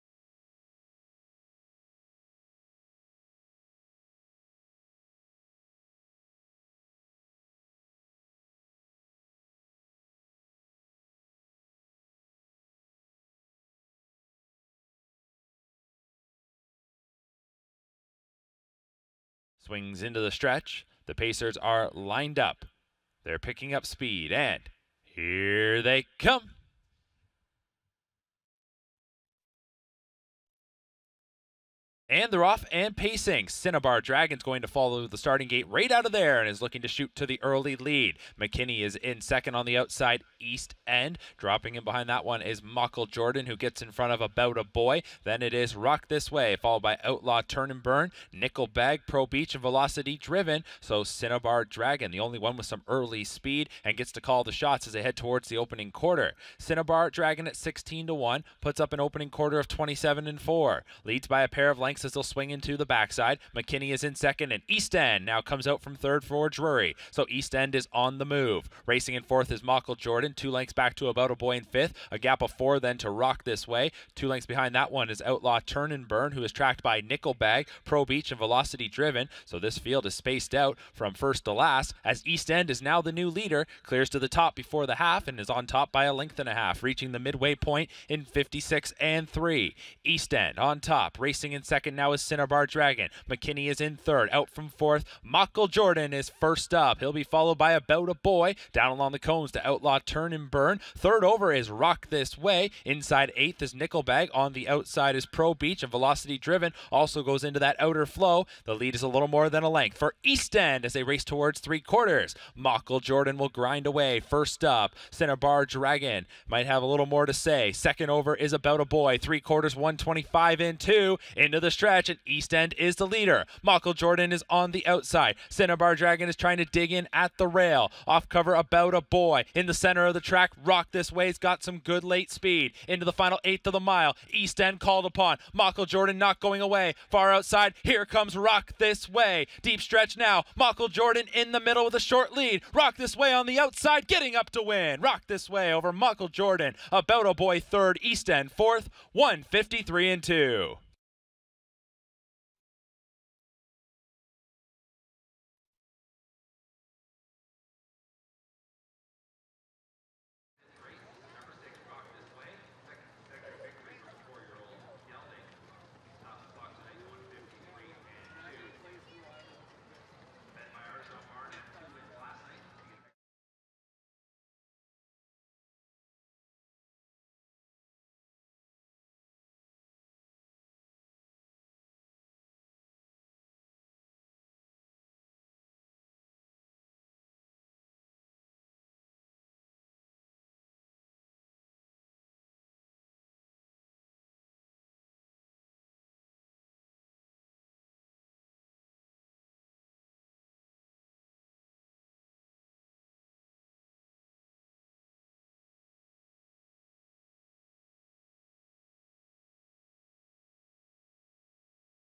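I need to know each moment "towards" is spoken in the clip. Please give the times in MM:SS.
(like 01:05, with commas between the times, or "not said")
00:55, 01:51.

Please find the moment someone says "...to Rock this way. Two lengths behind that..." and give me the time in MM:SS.
01:12.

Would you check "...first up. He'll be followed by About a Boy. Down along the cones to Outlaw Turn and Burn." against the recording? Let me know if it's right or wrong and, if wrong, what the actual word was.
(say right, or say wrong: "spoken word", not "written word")
right.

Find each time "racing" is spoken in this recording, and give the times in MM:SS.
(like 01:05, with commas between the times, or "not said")
01:08, 01:31.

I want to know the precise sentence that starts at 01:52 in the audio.
Michael Jordan will grind away first up.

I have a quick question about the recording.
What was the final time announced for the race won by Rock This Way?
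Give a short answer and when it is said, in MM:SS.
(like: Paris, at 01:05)
1:53.2, at 02:29.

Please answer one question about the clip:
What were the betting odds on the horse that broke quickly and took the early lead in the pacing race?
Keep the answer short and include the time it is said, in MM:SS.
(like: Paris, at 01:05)
16 to 1, at 00:57.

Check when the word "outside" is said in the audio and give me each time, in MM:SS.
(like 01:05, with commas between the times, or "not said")
00:39, 01:44, 02:04, 02:17, 02:23.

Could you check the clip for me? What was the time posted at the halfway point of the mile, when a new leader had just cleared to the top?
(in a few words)
56.3.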